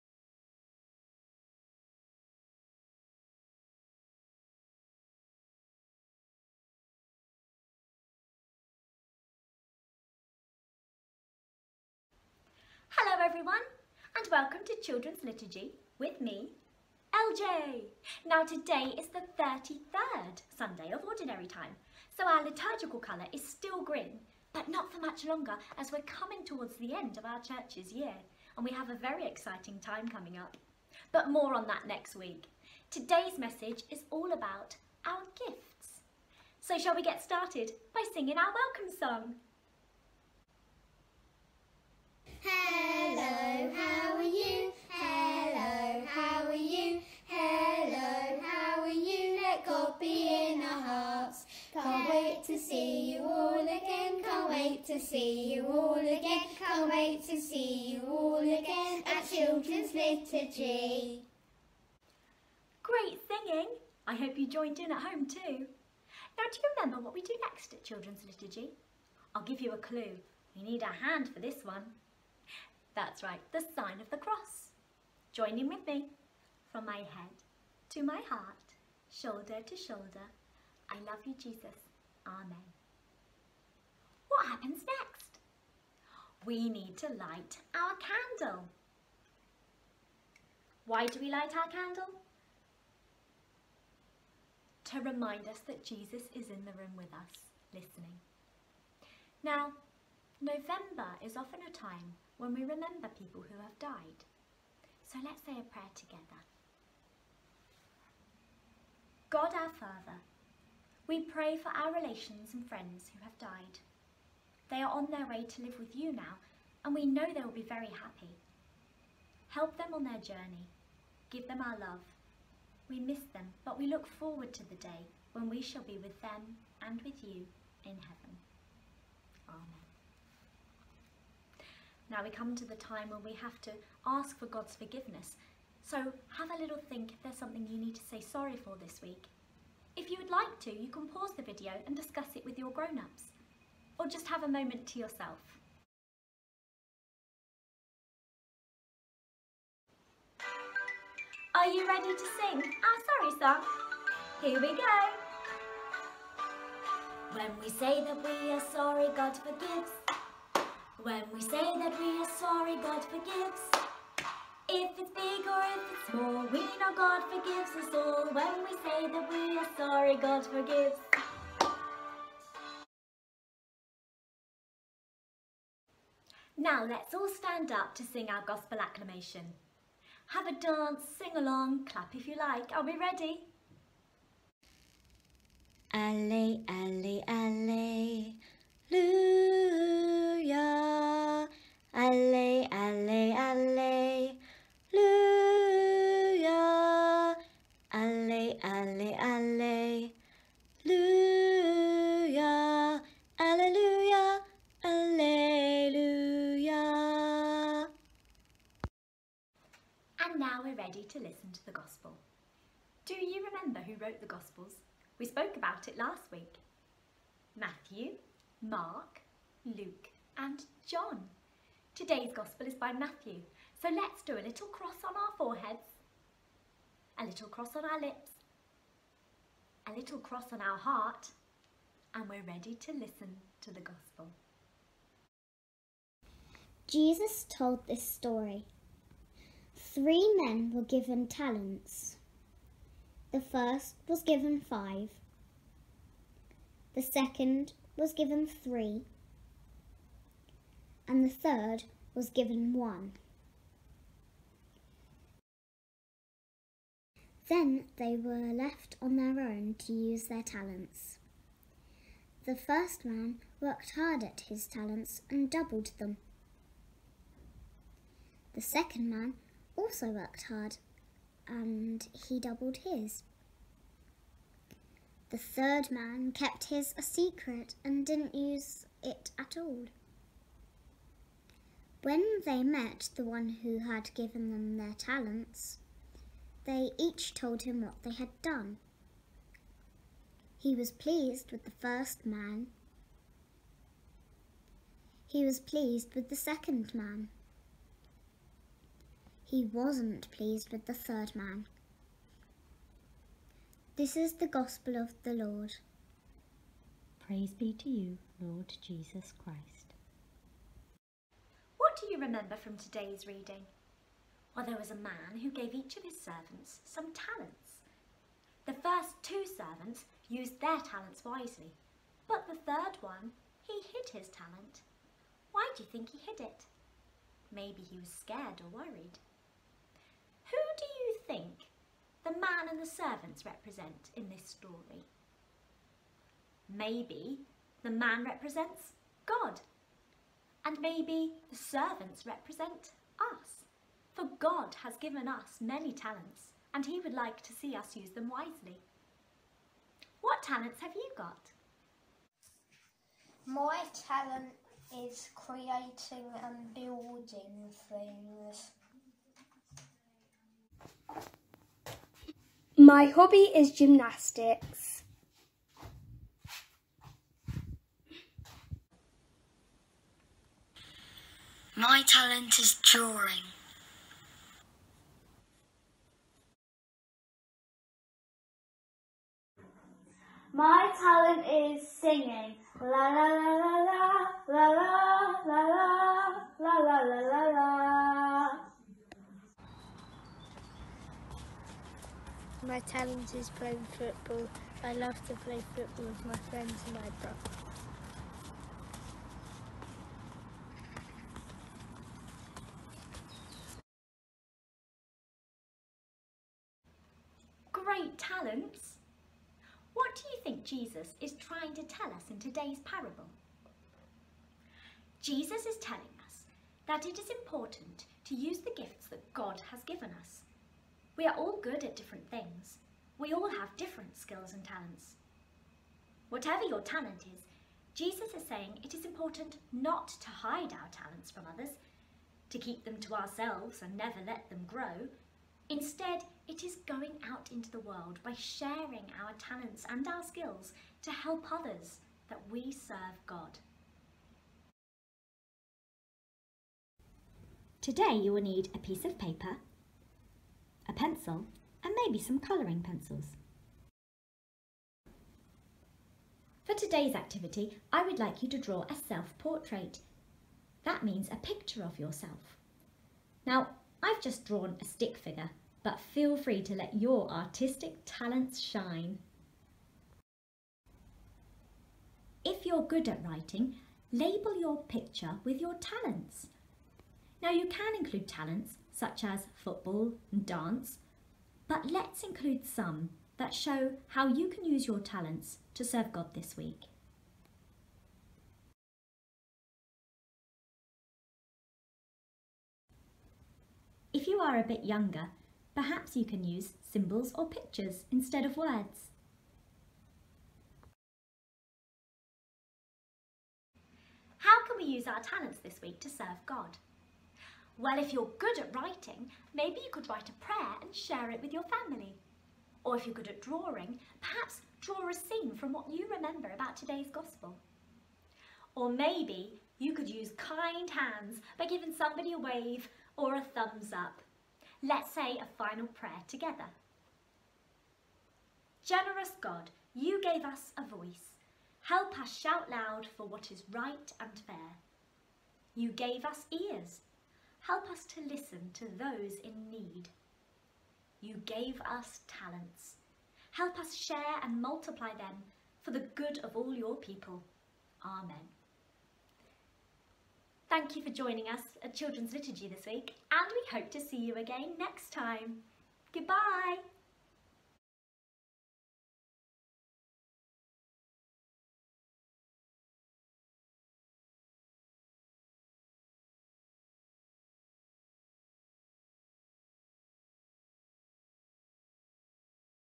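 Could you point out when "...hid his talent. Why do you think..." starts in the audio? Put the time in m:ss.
5:23.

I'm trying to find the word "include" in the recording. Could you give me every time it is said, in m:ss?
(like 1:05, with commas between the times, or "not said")
7:57, 8:02.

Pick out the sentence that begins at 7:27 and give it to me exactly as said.
Today you will need a piece of paper a pencil, and maybe some colouring pencils.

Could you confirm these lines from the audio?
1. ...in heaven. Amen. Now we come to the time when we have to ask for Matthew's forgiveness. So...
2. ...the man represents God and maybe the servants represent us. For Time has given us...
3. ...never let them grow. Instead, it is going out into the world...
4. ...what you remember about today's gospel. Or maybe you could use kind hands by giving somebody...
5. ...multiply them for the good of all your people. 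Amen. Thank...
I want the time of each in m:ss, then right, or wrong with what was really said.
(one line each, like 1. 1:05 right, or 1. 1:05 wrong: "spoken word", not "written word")
1. 2:07 wrong: "God", not "Matthew"
2. 5:37 wrong: "God", not "Time"
3. 7:13 right
4. 8:35 right
5. 9:04 right.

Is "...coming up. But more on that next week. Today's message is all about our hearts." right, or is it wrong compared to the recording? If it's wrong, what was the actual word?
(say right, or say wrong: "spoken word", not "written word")
wrong: "gifts", not "hearts".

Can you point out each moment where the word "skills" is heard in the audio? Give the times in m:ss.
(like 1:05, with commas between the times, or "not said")
7:04, 7:20.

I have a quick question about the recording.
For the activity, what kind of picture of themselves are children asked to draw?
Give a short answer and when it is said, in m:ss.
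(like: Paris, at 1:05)
Self-portrait, at 7:39.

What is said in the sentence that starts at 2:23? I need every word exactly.
Or just have a moment to yourself.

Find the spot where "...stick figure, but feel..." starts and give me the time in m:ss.
7:44.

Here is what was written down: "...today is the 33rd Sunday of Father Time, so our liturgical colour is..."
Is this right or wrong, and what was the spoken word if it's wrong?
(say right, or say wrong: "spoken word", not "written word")
wrong: "Ordinary", not "Father".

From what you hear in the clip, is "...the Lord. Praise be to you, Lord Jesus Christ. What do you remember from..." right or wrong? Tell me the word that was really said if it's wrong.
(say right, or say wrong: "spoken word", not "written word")
right.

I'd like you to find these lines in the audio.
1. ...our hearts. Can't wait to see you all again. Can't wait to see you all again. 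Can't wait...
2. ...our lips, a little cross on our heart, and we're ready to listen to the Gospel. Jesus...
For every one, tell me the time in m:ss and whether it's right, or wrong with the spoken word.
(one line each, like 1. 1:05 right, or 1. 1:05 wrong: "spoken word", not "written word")
1. 0:50 right
2. 3:47 right.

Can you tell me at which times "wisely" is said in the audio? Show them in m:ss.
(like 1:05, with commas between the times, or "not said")
5:21, 5:48.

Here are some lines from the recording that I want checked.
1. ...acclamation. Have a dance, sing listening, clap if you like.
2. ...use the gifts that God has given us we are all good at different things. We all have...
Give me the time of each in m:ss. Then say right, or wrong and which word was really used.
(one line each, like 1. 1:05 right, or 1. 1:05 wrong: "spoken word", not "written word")
1. 2:58 wrong: "along", not "listening"
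2. 6:58 right.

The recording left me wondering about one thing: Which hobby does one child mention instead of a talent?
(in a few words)
Gymnastics.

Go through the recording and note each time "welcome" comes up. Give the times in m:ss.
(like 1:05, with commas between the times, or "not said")
0:14, 0:38.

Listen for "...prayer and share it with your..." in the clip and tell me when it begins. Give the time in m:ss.
8:30.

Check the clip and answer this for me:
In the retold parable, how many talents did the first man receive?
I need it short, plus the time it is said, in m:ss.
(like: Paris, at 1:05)
5, at 4:04.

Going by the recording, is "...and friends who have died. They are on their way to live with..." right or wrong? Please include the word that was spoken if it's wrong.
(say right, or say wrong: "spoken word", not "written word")
right.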